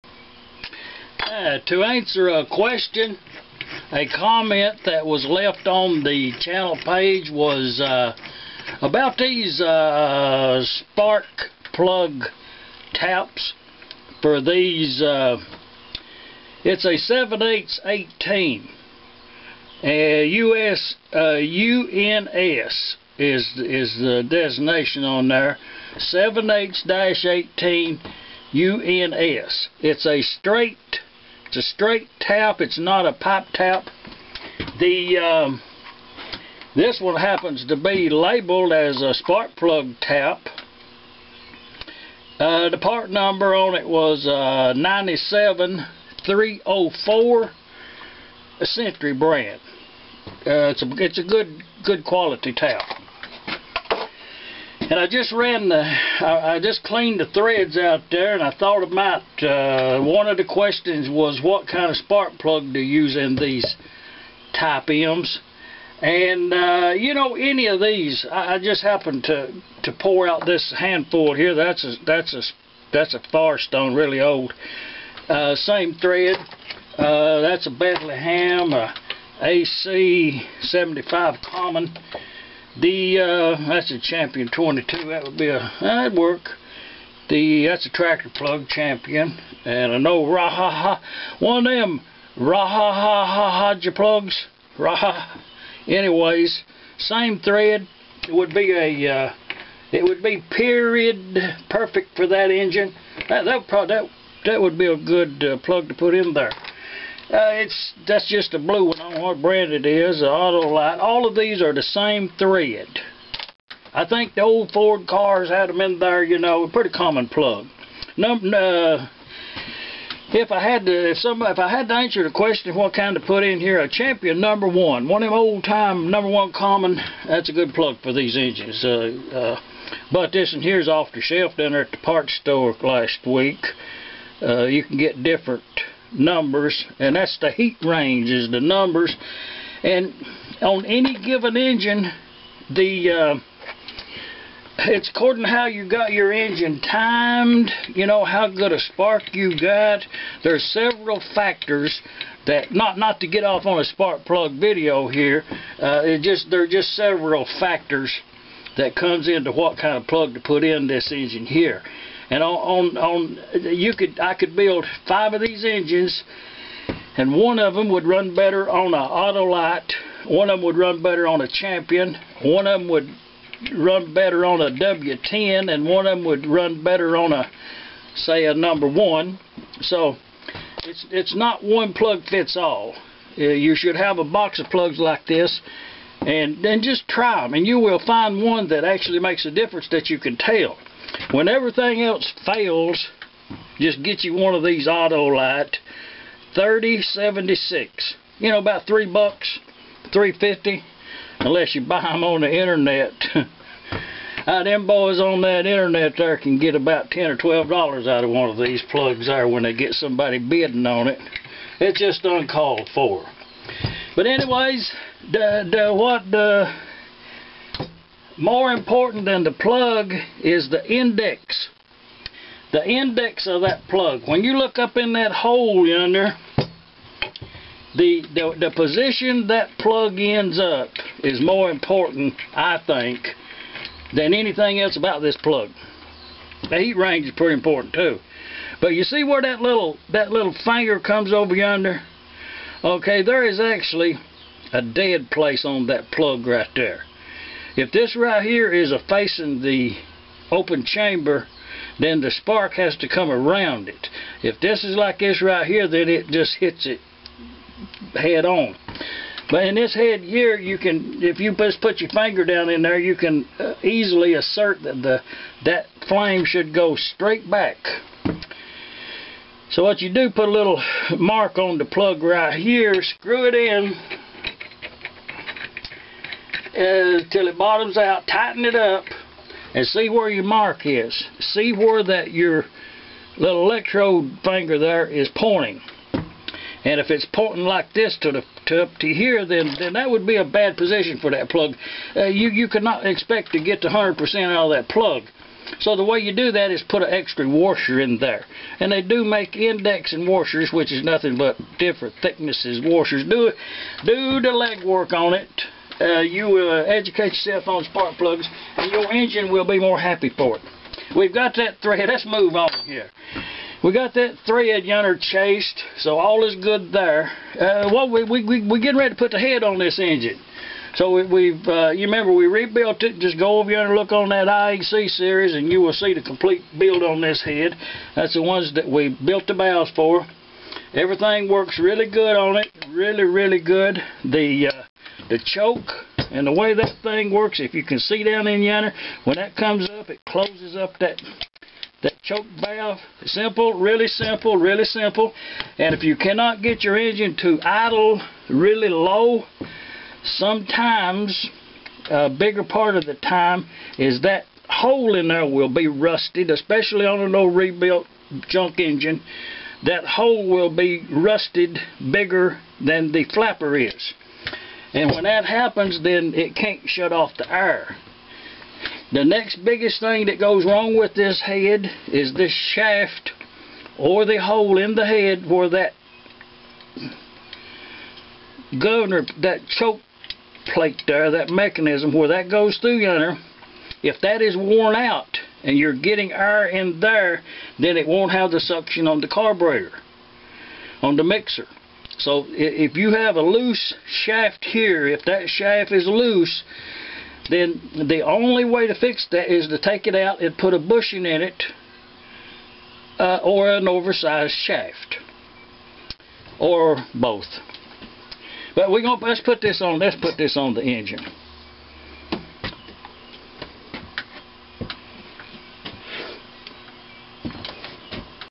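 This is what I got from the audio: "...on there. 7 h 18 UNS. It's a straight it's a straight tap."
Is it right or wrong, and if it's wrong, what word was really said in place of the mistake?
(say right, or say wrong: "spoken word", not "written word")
right.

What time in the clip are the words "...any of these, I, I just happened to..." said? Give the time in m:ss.
1:07.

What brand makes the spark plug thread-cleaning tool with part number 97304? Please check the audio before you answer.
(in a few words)
Century.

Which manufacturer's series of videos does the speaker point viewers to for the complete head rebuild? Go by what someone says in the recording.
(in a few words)
IHC.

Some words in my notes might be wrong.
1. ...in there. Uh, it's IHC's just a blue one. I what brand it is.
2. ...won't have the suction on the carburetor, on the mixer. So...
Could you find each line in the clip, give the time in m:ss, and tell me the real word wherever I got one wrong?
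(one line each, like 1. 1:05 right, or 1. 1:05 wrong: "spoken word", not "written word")
1. 1:46 wrong: "That", not "IHC"
2. 6:28 right.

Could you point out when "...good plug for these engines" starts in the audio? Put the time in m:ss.
2:07.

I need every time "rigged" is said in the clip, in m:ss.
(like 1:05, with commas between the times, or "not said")
not said.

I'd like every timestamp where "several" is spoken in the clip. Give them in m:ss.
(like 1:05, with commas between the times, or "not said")
2:30, 2:36.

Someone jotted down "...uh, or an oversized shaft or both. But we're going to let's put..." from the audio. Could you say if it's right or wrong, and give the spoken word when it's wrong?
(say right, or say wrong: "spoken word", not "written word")
right.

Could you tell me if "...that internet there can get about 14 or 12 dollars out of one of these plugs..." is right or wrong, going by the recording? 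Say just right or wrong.
wrong.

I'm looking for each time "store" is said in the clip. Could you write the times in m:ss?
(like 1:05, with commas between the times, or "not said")
2:12.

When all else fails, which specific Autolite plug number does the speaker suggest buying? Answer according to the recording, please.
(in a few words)
3076.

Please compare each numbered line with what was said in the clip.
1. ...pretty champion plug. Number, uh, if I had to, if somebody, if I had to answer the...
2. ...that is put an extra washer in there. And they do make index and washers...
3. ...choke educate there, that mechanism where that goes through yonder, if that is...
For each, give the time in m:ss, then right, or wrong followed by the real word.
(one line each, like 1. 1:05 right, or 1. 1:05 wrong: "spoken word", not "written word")
1. 1:56 wrong: "common", not "champion"
2. 4:56 right
3. 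6:19 wrong: "plate", not "educate".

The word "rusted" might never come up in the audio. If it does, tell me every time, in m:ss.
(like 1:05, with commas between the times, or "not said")
5:55, 6:01.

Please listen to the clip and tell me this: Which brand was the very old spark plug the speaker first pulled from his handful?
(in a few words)
Firestone.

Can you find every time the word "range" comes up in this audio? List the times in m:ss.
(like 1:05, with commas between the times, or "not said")
2:17, 3:56.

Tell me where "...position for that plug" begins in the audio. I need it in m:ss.
4:50.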